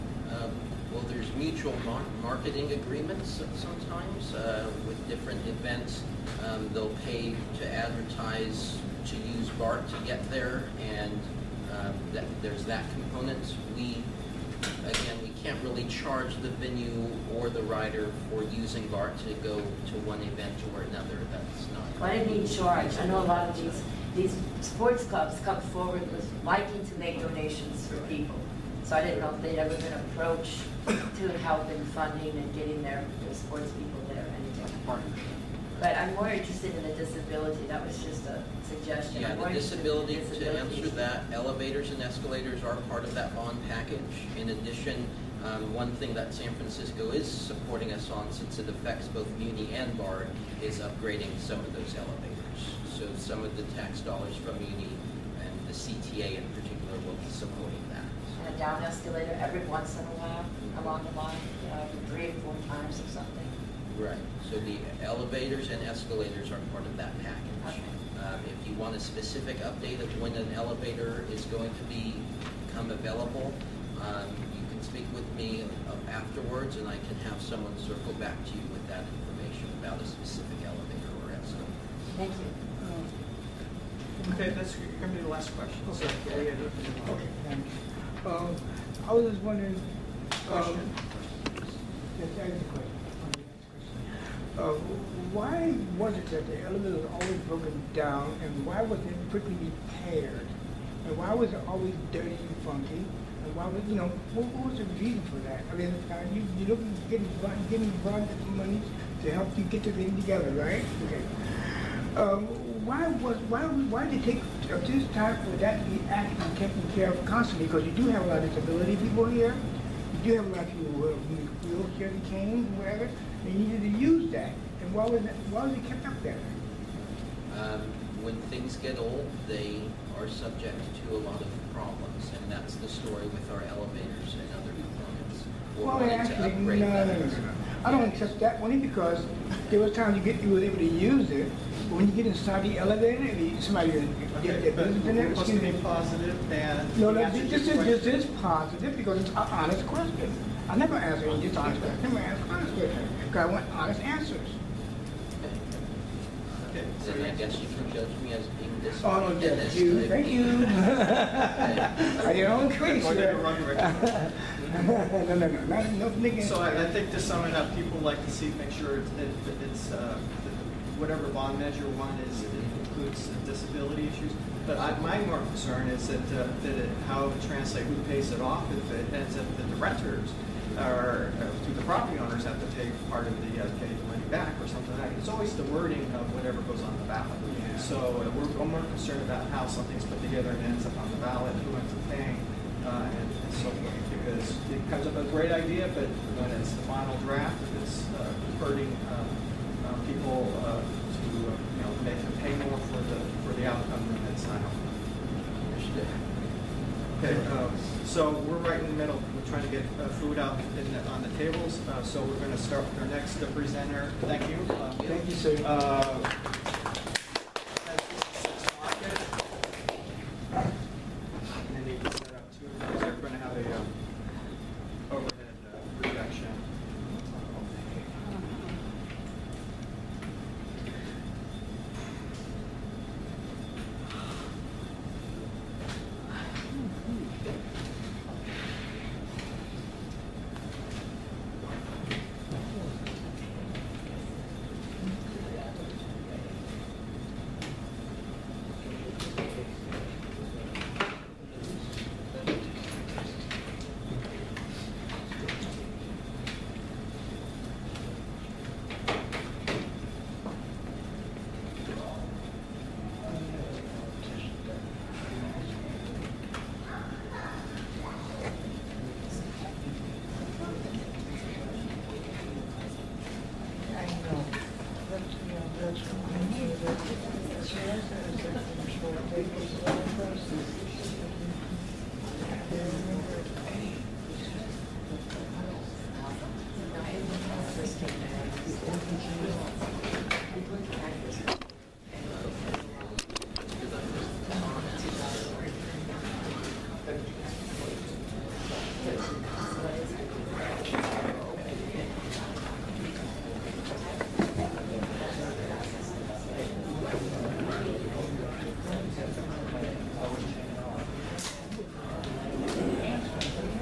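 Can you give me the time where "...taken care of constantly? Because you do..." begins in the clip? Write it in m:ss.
1:56.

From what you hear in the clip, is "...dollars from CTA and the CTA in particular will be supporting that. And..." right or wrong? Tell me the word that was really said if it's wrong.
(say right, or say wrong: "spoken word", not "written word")
wrong: "Uni", not "CTA".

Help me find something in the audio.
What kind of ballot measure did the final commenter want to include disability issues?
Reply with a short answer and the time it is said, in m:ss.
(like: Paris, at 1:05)
Bond measure, at 2:51.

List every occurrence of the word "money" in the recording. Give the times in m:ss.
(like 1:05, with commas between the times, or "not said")
1:48, 3:04.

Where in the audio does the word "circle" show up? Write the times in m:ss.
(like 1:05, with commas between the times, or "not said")
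1:17.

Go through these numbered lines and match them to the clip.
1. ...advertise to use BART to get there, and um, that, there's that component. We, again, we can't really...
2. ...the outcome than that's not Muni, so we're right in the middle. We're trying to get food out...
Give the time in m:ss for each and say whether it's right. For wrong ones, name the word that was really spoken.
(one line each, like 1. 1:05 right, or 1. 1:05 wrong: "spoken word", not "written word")
1. 0:07 right
2. 3:23 wrong: "Okay", not "Muni".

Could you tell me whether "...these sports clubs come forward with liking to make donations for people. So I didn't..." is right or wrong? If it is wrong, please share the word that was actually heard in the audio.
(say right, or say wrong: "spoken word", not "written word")
right.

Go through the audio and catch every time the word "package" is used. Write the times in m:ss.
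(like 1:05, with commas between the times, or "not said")
0:43, 1:07.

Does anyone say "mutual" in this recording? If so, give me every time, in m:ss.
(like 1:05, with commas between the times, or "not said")
0:01.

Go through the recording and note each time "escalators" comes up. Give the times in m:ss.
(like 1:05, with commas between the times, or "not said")
0:42, 0:58, 1:05, 1:21.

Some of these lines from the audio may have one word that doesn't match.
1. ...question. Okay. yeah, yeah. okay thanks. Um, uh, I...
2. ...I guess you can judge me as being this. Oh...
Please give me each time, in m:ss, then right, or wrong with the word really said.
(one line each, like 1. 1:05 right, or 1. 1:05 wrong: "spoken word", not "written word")
1. 1:25 right
2. 2:37 right.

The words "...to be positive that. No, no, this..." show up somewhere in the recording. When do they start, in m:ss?
2:25.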